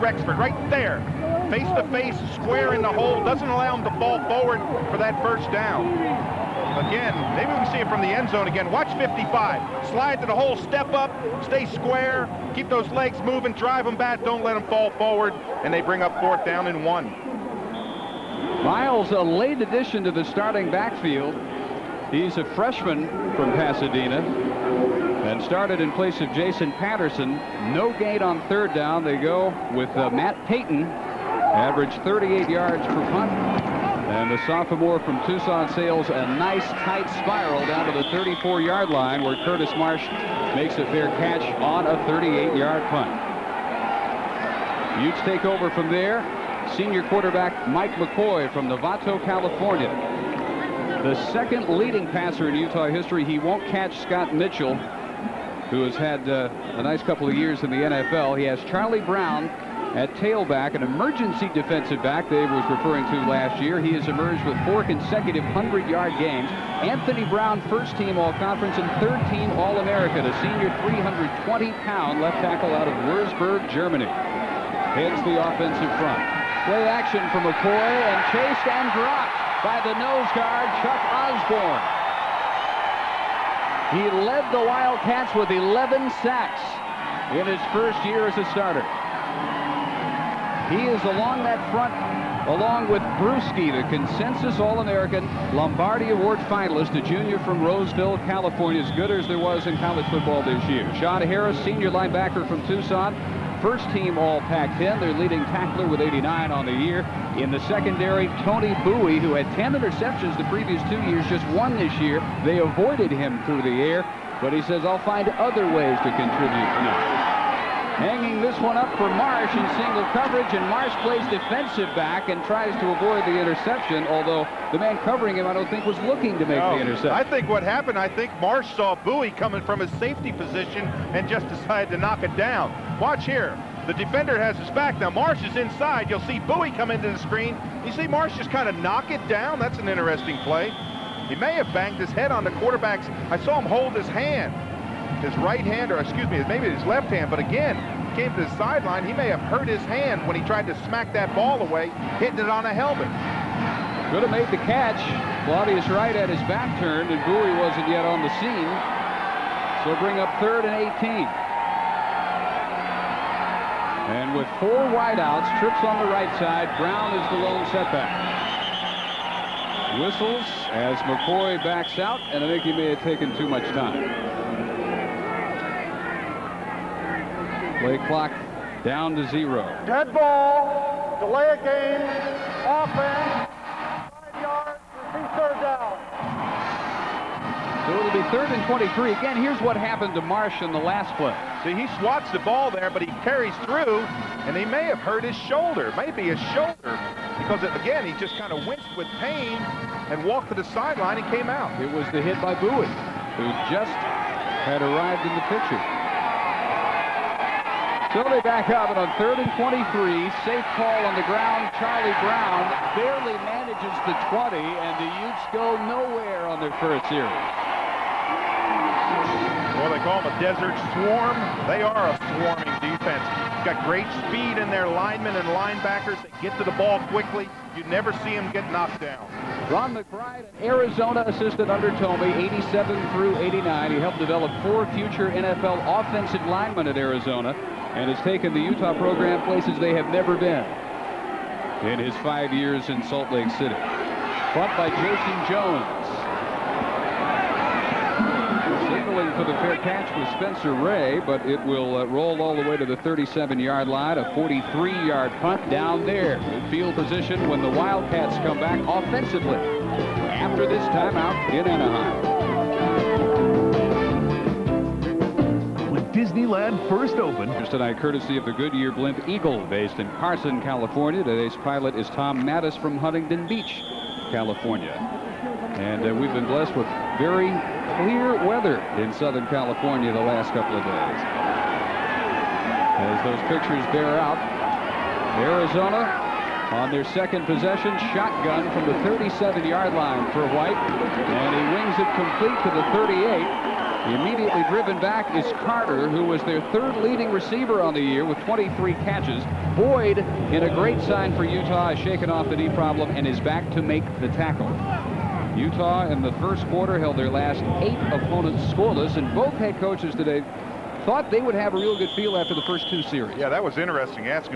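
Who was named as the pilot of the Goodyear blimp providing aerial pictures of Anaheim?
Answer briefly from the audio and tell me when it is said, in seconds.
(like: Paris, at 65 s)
Tom Mattis, at 272 s.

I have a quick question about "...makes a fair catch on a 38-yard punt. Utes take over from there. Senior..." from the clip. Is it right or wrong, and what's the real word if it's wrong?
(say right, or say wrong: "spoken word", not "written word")
right.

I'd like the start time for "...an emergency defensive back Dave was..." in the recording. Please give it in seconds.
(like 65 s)
60 s.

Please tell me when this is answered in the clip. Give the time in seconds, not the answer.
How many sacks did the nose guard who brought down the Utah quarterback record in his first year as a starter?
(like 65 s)
85 s.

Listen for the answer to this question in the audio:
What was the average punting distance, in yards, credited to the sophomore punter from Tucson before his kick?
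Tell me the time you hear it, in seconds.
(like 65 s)
30 s.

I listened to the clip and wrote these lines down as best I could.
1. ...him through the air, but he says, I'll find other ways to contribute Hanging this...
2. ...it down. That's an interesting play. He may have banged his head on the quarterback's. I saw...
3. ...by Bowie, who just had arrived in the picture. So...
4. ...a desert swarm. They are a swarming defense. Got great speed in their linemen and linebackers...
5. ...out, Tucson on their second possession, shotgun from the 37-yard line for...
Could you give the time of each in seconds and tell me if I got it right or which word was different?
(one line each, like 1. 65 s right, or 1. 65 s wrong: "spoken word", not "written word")
1. 113 s right
2. 139 s right
3. 202 s right
4. 220 s right
5. 284 s wrong: "Arizona", not "Tucson".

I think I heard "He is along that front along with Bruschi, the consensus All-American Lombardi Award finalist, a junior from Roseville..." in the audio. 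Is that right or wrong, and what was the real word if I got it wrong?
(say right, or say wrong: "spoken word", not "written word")
right.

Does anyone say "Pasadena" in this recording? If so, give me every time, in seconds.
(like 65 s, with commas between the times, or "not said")
23 s.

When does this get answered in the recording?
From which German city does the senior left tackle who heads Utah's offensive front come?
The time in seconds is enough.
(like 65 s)
73 s.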